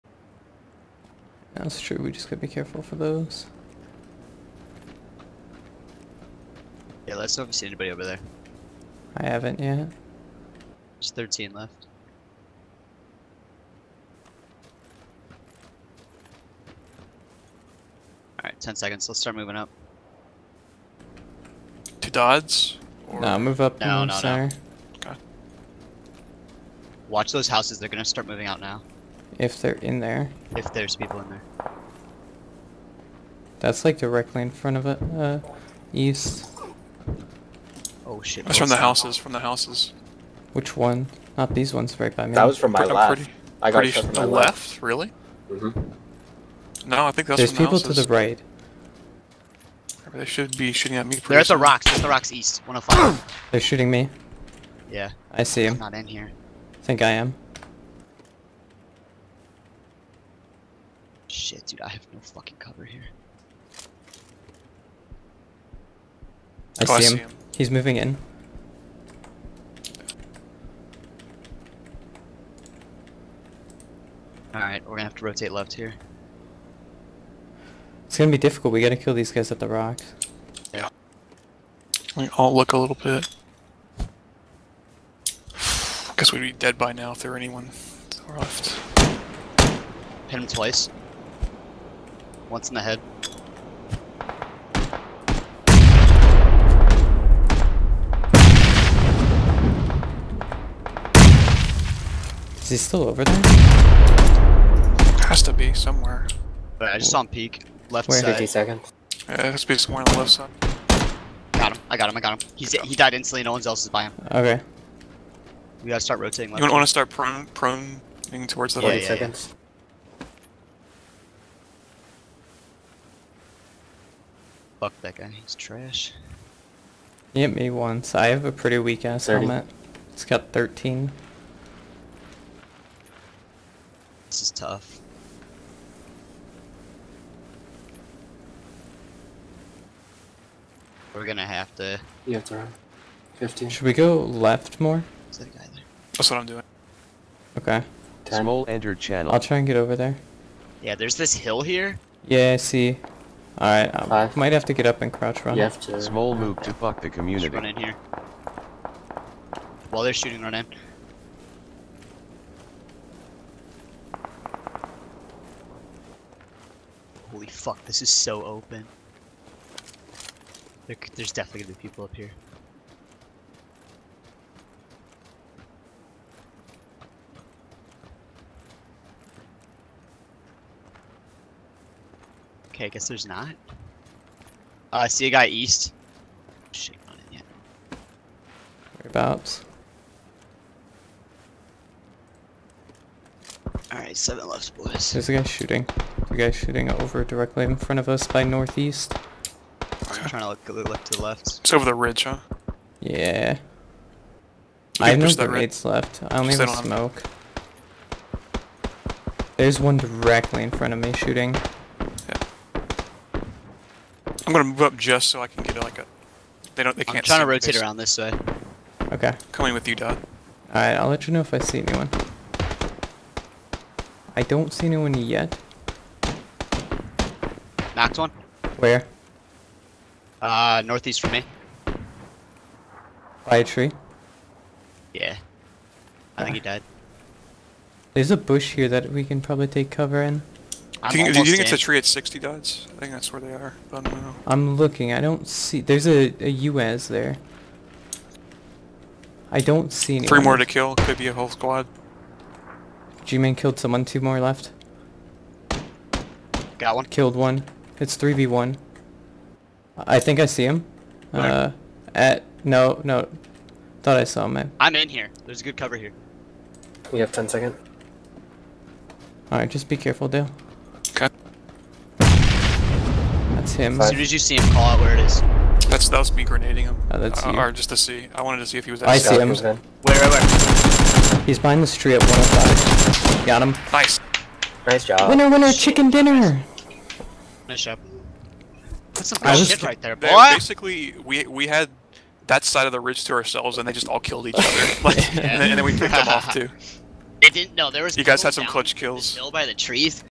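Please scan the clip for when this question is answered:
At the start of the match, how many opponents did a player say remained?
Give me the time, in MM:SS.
00:10.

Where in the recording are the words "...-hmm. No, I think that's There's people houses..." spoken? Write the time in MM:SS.
00:45.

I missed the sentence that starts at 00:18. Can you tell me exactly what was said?
Alright, 10 seconds, let's start moving up.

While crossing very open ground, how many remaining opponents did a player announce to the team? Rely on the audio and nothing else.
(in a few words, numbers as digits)
7.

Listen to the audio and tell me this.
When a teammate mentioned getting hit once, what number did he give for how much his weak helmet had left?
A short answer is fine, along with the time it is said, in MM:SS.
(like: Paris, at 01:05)
13, at 02:10.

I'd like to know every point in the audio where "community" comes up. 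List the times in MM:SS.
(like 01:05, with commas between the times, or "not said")
02:37.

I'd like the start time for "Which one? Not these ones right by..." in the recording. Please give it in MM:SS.
00:40.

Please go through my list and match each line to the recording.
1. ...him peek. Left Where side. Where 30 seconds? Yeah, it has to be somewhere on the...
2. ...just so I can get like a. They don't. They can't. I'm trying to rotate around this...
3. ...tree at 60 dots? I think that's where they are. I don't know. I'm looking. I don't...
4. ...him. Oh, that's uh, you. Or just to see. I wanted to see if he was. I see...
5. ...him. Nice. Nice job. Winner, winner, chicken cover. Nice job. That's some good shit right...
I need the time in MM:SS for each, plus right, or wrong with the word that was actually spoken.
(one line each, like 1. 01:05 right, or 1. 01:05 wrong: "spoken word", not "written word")
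1. 01:47 wrong: "50", not "30"
2. 03:34 right
3. 04:01 right
4. 04:36 right
5. 04:43 wrong: "dinner", not "cover".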